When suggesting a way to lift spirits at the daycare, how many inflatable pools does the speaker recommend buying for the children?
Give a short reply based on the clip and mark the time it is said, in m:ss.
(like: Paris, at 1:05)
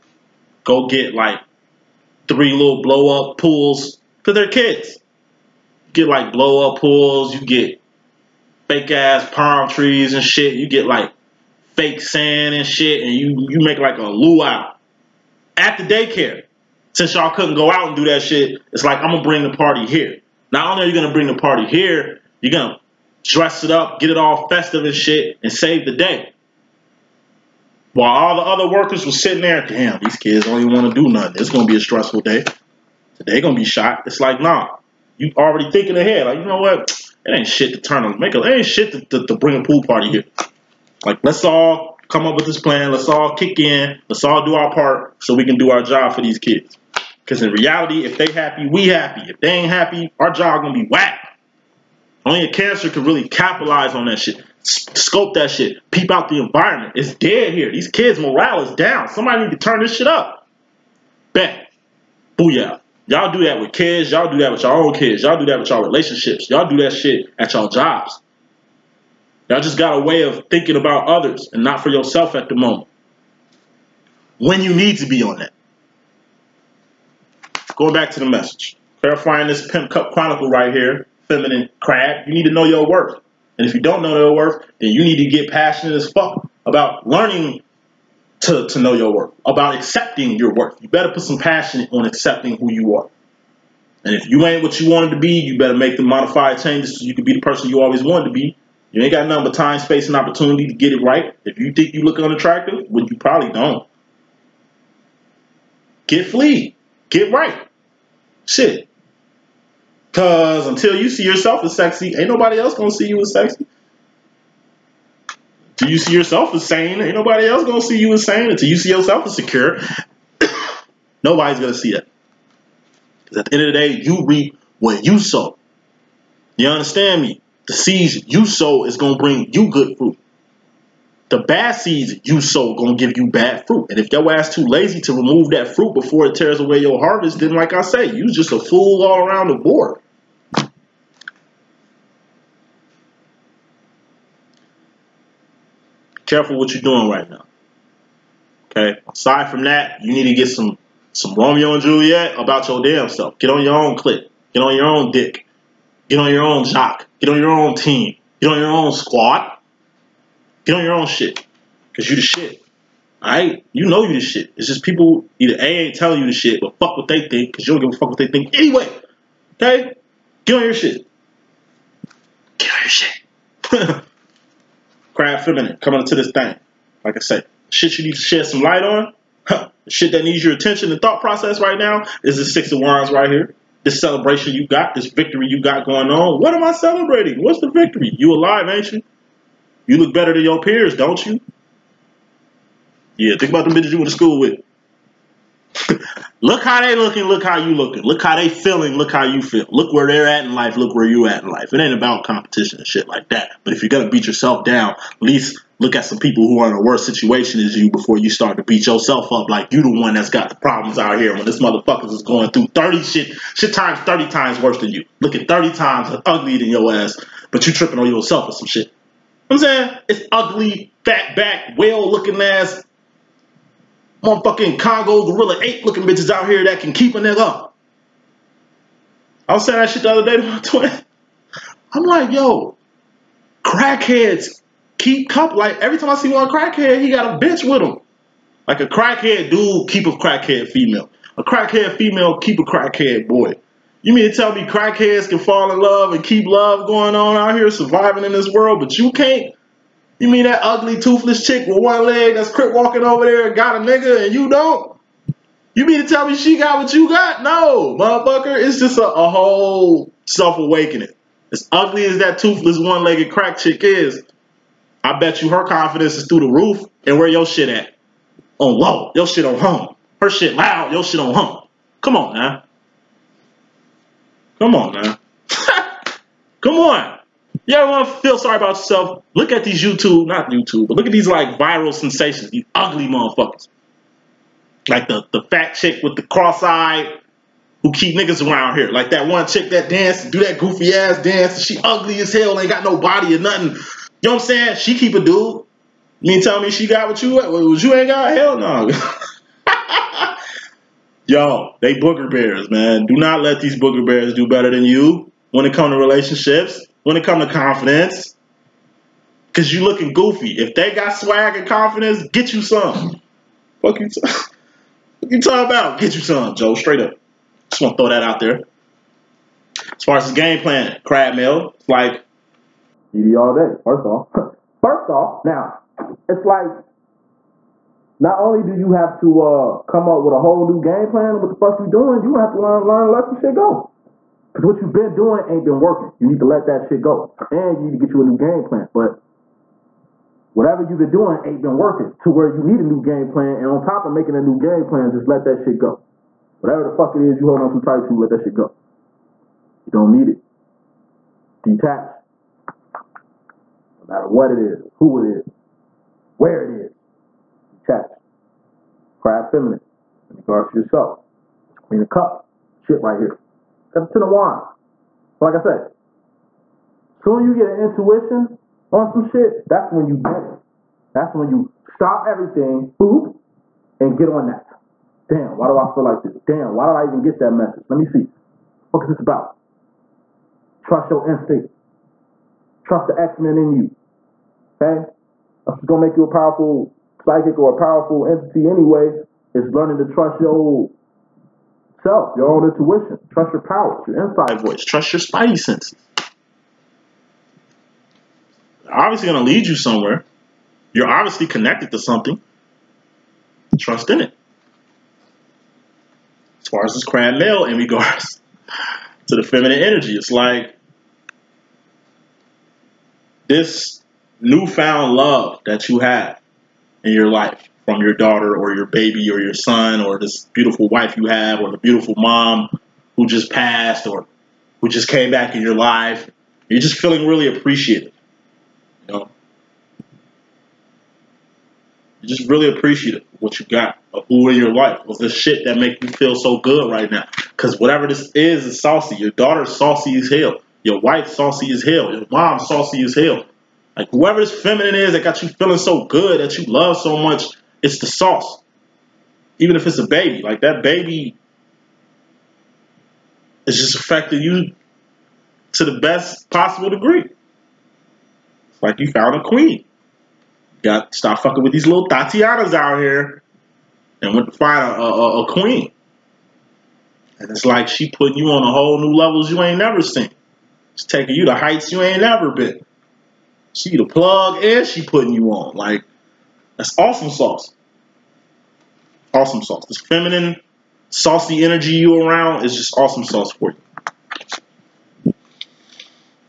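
3, at 0:02.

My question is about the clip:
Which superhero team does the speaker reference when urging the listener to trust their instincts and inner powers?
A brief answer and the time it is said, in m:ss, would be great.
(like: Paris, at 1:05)
X-Men, at 6:23.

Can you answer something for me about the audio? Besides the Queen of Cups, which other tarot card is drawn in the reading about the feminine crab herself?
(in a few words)
Ten of Wands.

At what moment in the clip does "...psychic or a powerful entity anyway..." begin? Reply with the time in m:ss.
6:27.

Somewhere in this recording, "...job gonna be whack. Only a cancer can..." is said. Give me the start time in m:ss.
0:50.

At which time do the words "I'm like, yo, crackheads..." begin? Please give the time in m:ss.
3:51.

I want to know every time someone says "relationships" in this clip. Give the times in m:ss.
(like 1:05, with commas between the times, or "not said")
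1:05, 5:05.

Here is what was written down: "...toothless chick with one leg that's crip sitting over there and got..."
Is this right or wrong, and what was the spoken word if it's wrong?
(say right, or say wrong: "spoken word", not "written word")
wrong: "walking", not "sitting".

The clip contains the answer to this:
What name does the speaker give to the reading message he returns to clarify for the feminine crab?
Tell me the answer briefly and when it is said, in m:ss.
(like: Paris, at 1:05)
Pimp Cup Chronicle, at 1:19.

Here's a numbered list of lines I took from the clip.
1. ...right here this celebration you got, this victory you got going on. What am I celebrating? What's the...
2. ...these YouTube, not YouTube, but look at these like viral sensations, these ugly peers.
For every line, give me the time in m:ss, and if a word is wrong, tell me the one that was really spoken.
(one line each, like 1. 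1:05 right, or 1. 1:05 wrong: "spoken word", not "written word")
1. 3:03 right
2. 4:39 wrong: "motherfuckers", not "peers".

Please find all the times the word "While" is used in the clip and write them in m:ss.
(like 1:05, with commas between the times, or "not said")
0:27.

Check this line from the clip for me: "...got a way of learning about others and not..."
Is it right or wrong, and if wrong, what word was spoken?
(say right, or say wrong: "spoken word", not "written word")
wrong: "thinking", not "learning".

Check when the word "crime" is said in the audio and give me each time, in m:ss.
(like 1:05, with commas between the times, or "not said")
not said.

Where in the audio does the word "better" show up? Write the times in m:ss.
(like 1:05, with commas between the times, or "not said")
1:30, 1:35, 3:10, 5:04.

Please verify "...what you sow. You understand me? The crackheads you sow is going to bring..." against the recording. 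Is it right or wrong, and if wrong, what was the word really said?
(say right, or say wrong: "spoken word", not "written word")
wrong: "seeds", not "crackheads".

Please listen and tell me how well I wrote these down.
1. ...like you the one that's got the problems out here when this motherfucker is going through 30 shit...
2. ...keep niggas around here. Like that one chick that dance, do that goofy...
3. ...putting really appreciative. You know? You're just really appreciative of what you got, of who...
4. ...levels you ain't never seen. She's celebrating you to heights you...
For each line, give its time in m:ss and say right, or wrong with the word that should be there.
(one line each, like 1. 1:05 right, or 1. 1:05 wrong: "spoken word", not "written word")
1. 3:29 right
2. 4:47 right
3. 7:06 wrong: "feeling", not "putting"
4. 7:49 wrong: "taking", not "celebrating".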